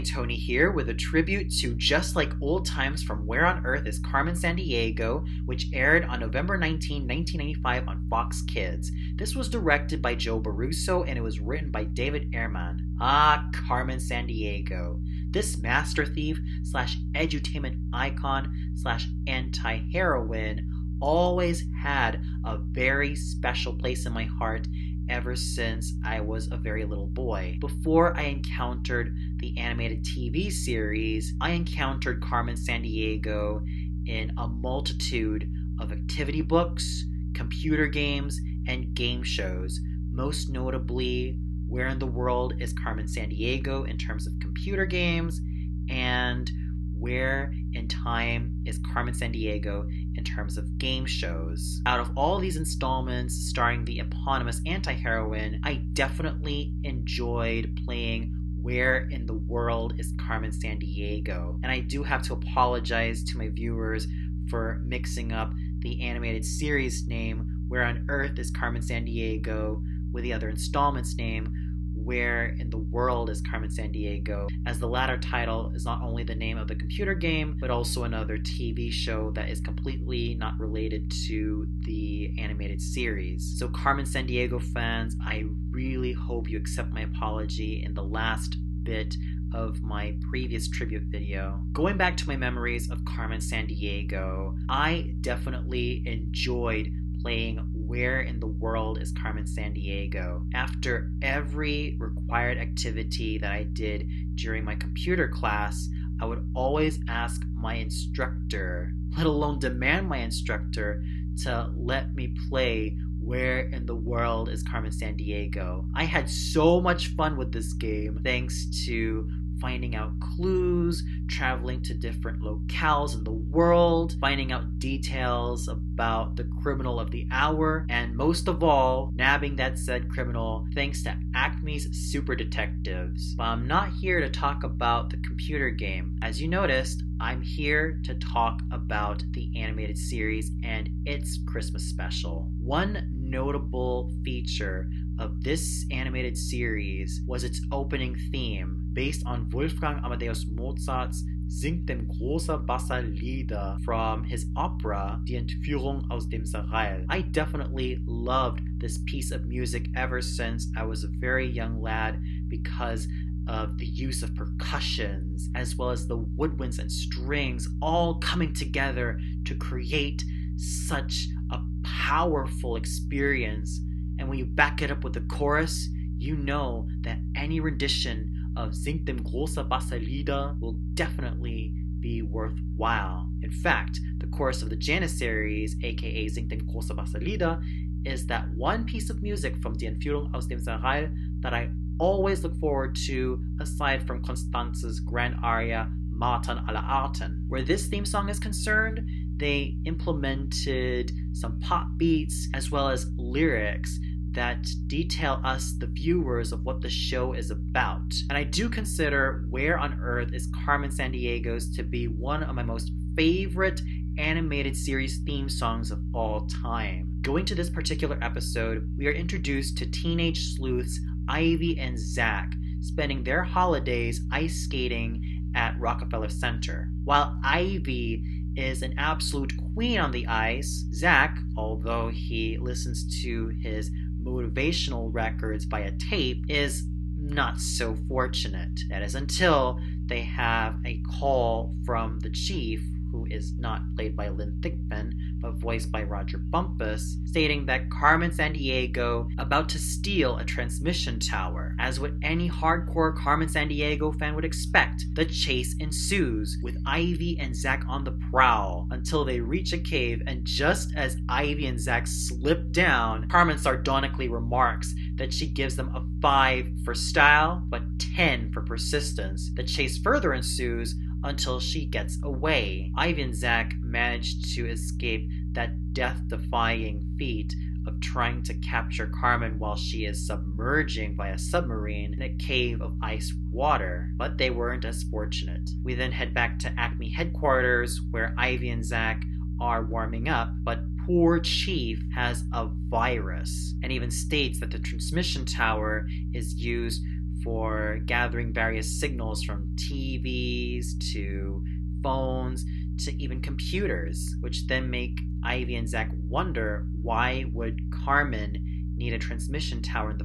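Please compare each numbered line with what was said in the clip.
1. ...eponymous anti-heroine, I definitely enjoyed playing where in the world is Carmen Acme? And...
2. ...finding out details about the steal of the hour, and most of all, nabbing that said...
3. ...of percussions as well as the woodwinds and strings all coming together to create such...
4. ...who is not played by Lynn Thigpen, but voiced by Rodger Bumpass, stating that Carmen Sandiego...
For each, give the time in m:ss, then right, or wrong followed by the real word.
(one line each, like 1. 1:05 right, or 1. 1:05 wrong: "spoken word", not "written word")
1. 0:53 wrong: "Sandiego", not "Acme"
2. 2:04 wrong: "criminal", not "steal"
3. 2:44 right
4. 4:03 right.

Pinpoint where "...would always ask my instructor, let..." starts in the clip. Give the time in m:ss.
1:46.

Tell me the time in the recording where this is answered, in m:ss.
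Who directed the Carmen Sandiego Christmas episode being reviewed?
0:10.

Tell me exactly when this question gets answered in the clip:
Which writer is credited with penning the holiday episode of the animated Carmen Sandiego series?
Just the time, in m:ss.
0:11.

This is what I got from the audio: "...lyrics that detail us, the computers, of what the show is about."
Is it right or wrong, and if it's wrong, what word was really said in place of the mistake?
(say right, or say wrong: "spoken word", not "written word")
wrong: "viewers", not "computers".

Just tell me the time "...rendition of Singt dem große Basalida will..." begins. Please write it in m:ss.
2:57.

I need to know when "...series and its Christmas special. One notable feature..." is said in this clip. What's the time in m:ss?
2:19.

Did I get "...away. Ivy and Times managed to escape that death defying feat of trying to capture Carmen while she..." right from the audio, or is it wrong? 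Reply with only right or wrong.
wrong.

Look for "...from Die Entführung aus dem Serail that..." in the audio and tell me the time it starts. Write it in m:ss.
3:09.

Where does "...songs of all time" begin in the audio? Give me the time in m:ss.
3:35.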